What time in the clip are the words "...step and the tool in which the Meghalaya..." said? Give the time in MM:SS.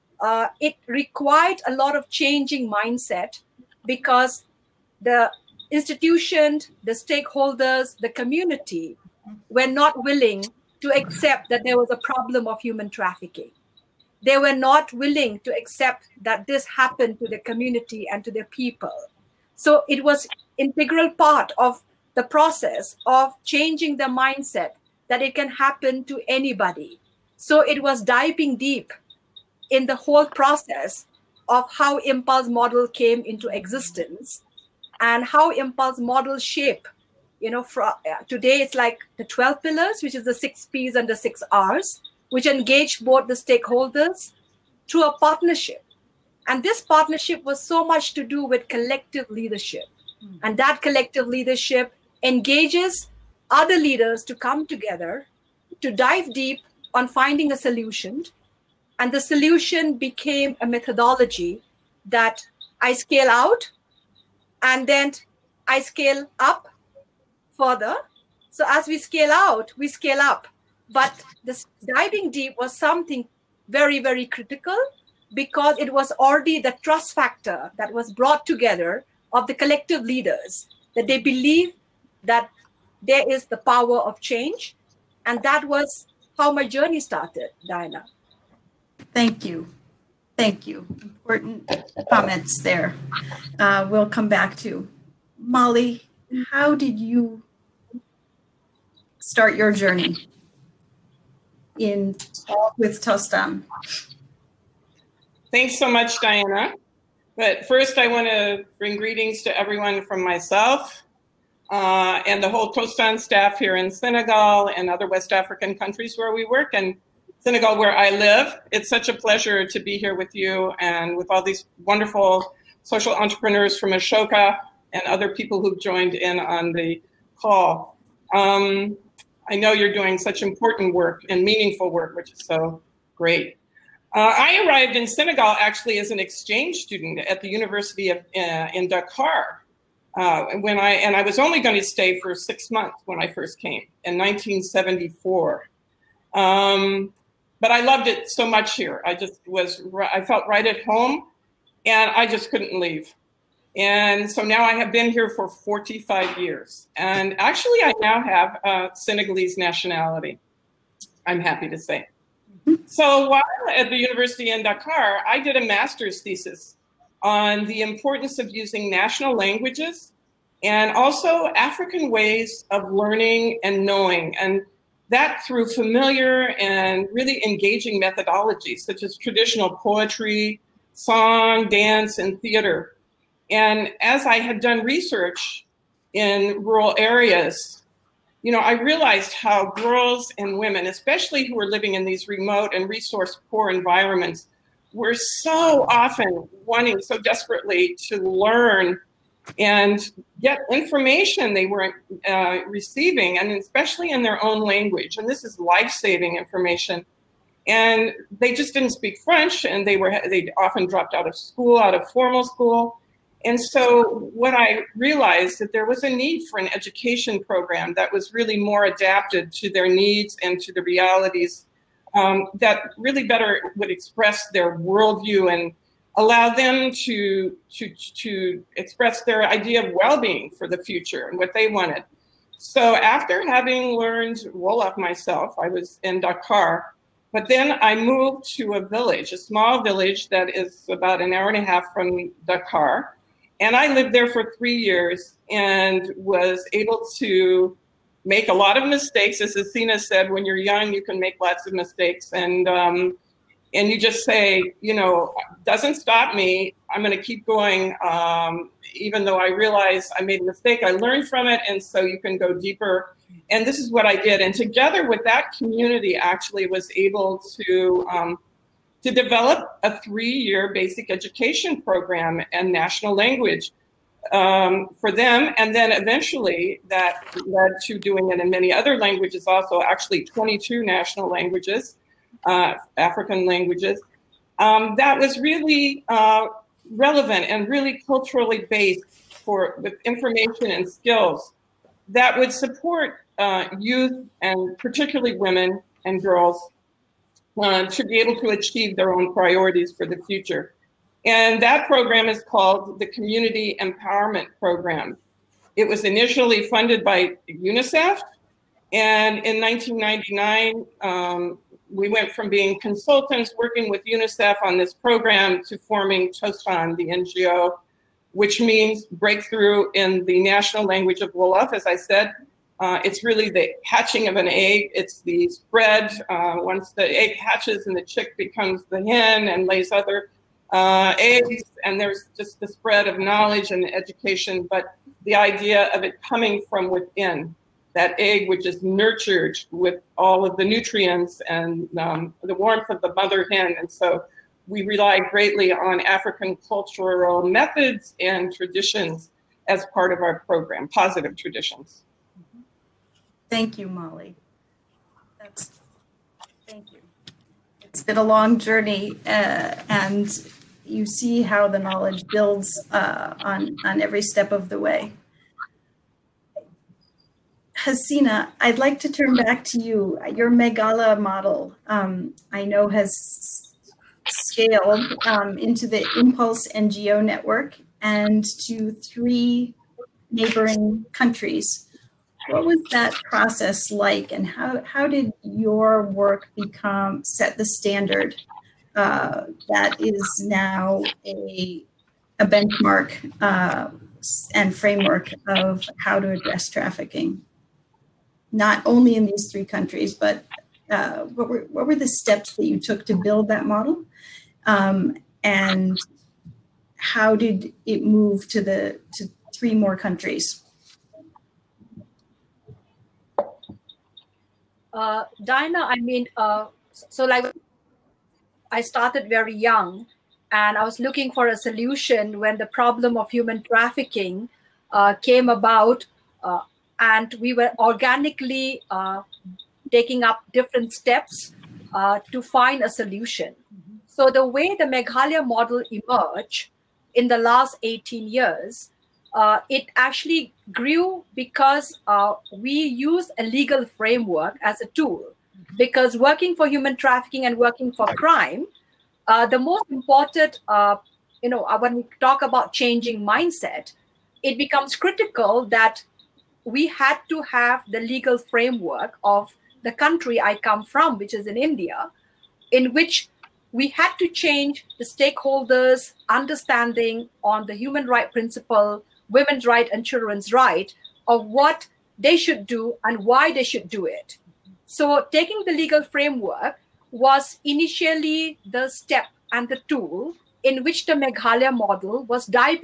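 07:58.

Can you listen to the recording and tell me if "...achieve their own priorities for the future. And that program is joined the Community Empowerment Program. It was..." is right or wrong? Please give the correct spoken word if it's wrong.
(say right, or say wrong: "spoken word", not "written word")
wrong: "called", not "joined".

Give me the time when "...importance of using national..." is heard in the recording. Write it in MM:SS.
02:47.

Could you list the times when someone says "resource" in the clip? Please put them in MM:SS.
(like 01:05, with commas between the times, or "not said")
03:12.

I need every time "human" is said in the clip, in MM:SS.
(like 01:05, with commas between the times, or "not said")
00:12, 07:03, 07:26, 07:47.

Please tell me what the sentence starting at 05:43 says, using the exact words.
And so we rely greatly on African cultural methods and traditions as part of our program, positive traditions.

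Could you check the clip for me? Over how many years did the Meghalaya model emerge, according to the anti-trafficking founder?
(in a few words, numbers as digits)
18.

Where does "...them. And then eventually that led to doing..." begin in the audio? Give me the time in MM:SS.
04:35.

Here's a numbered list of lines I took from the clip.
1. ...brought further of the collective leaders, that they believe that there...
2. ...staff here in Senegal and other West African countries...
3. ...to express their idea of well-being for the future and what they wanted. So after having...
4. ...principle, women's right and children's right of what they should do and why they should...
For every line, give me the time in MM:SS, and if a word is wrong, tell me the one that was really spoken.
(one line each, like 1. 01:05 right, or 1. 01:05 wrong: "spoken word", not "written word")
1. 01:18 wrong: "together", not "further"
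2. 01:53 right
3. 03:48 right
4. 07:48 right.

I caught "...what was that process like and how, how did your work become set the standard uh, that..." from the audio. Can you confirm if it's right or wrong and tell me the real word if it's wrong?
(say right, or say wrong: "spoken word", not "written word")
right.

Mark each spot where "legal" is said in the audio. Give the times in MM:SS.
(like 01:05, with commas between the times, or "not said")
07:23, 07:38, 07:55.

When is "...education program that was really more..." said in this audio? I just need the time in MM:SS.
03:36.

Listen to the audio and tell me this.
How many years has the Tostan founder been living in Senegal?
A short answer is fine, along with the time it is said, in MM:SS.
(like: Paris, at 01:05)
45, at 02:35.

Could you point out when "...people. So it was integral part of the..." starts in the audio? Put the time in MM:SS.
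00:18.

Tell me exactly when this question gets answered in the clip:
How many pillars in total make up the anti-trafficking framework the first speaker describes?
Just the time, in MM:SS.
00:39.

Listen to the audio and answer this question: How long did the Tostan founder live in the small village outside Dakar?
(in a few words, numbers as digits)
3 years.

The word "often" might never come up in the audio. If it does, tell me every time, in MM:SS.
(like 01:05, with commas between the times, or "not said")
03:15, 03:30.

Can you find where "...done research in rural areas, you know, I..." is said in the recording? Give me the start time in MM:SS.
03:04.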